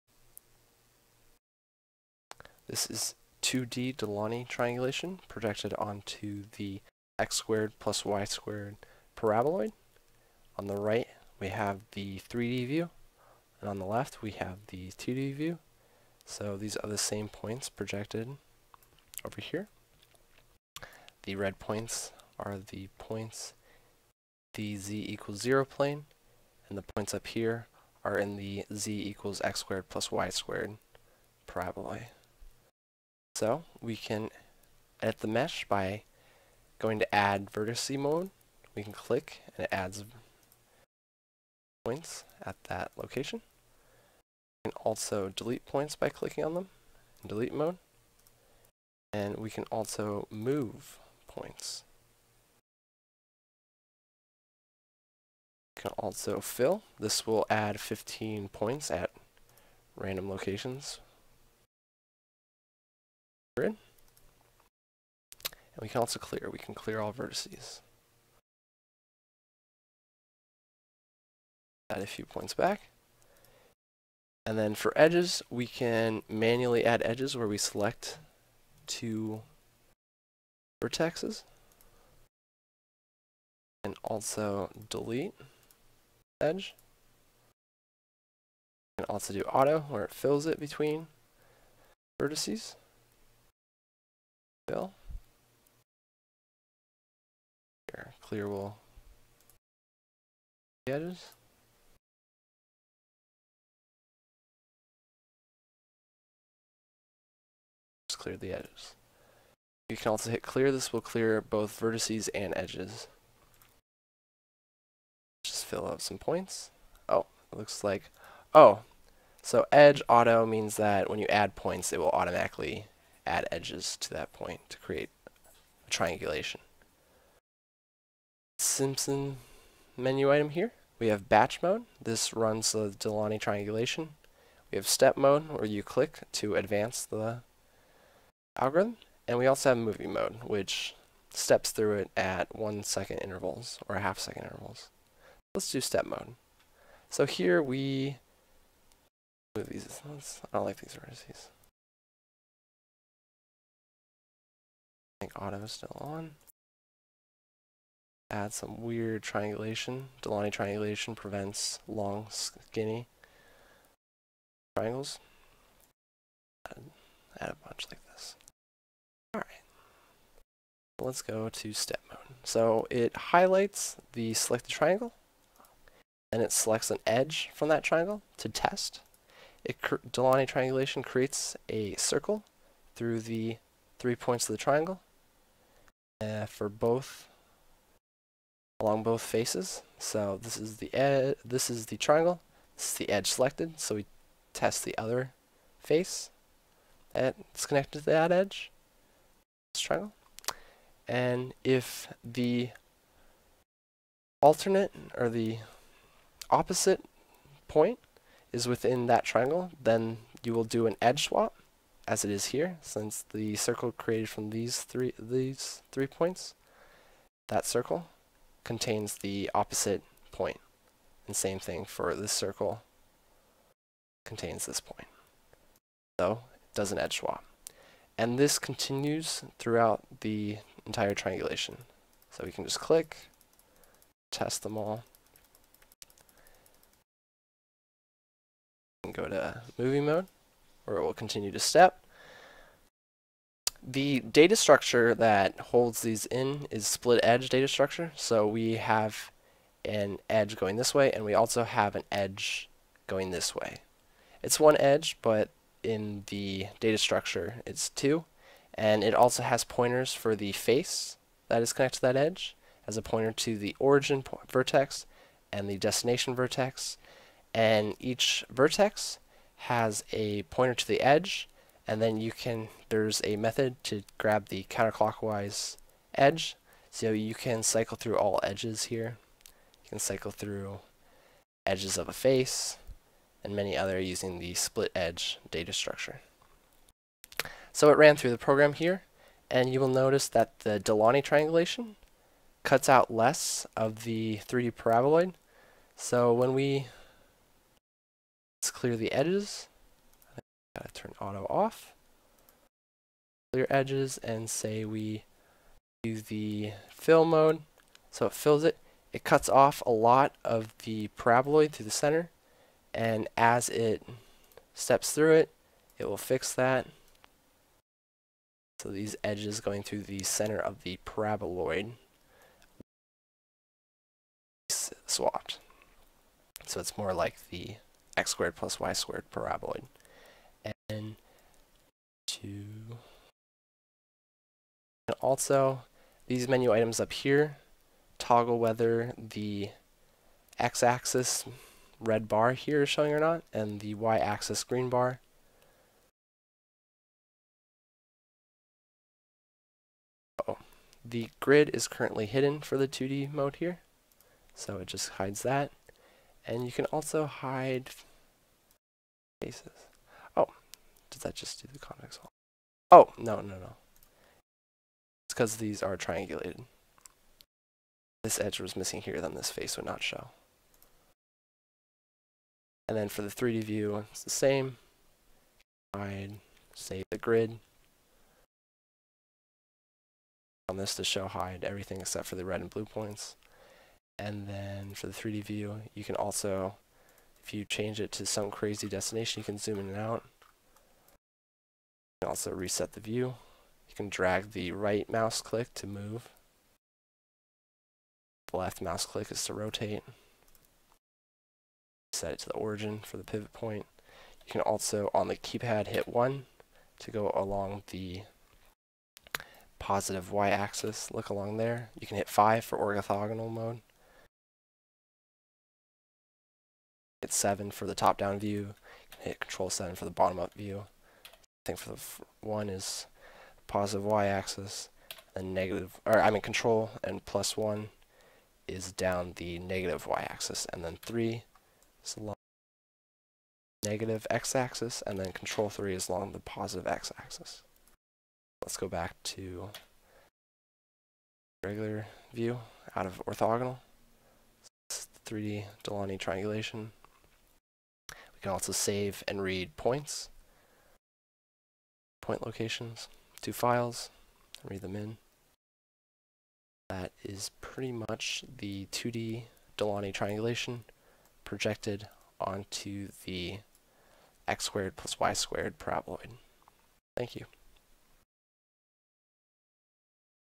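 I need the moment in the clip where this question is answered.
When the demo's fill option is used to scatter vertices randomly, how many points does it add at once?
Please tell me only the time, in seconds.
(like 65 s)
57 s.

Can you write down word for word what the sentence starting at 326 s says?
So it's more like the x squared plus y squared paraboloid.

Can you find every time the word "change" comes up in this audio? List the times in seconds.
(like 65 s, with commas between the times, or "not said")
387 s.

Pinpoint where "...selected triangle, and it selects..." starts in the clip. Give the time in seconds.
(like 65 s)
174 s.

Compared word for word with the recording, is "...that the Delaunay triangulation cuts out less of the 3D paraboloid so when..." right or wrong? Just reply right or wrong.
right.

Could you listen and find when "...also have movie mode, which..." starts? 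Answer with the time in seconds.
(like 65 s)
139 s.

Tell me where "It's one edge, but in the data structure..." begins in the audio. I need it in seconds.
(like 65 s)
254 s.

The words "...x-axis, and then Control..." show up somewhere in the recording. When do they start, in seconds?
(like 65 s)
434 s.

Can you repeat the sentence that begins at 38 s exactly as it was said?
We can click and it adds points at that location.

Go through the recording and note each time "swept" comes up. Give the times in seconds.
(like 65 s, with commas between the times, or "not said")
not said.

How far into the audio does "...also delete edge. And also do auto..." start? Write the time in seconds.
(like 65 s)
84 s.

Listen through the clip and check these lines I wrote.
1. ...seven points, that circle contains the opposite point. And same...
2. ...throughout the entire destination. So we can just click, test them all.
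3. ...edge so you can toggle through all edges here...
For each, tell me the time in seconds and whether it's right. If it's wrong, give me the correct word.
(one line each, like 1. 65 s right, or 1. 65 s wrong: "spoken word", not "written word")
1. 215 s wrong: "three", not "seven"
2. 229 s wrong: "triangulation", not "destination"
3. 276 s wrong: "cycle", not "toggle".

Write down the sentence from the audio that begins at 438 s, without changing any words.
Let's go back to regular view out of orthogonal.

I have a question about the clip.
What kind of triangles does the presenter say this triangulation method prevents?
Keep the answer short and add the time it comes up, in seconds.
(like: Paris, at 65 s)
long, skinny triangles, at 161 s.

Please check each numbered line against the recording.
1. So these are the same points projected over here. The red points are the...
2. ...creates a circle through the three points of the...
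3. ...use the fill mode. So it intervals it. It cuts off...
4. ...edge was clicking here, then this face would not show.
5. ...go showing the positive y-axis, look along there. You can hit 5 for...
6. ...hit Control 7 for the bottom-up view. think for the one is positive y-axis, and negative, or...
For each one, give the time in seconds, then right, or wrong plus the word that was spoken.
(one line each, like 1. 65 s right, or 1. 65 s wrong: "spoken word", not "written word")
1. 16 s right
2. 181 s right
3. 306 s wrong: "fills", not "intervals"
4. 368 s wrong: "missing", not "clicking"
5. 407 s wrong: "along", not "showing"
6. 419 s right.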